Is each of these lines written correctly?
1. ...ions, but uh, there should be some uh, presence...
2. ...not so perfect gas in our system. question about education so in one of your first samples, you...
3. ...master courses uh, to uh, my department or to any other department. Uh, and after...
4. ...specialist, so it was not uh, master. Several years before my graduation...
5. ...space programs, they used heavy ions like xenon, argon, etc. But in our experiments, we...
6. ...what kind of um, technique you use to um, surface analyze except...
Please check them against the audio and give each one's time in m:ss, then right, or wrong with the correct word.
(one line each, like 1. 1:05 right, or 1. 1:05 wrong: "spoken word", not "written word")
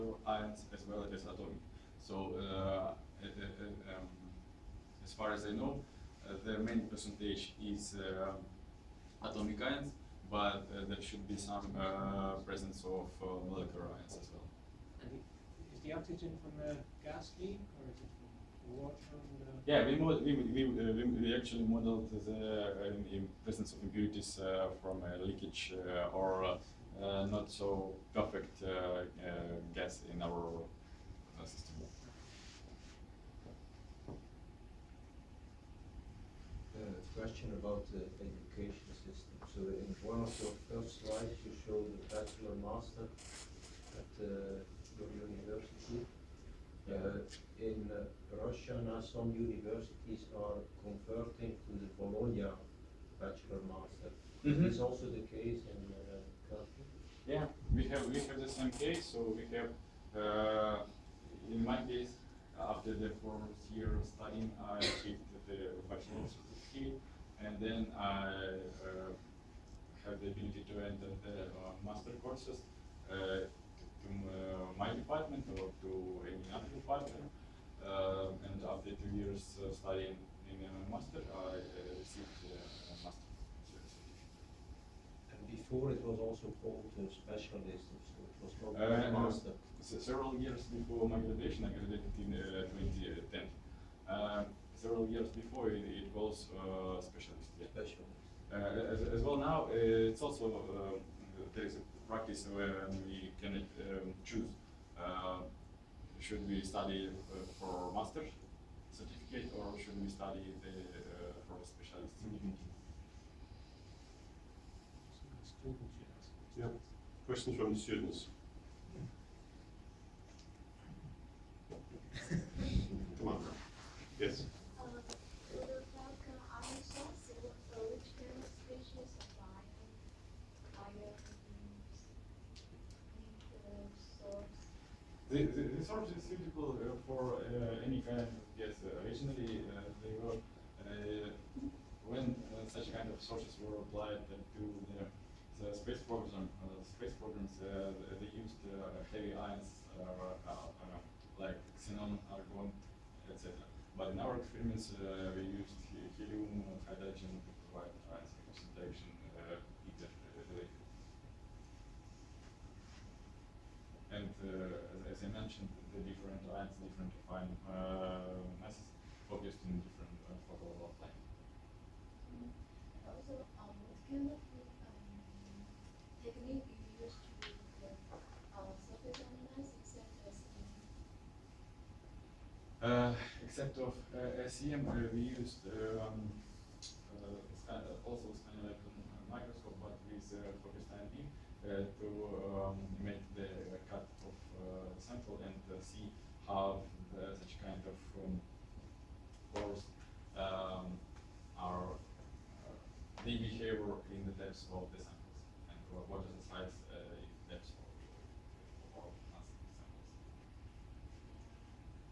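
1. 0:09 right
2. 0:27 wrong: "slides", not "samples"
3. 1:11 right
4. 1:27 right
5. 2:26 right
6. 2:53 right.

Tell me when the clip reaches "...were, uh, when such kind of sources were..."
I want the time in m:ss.
2:20.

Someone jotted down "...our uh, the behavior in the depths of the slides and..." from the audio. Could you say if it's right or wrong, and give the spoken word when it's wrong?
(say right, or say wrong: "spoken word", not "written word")
wrong: "samples", not "slides".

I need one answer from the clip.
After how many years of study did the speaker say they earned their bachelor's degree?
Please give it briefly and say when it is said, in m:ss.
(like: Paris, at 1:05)
4, at 1:03.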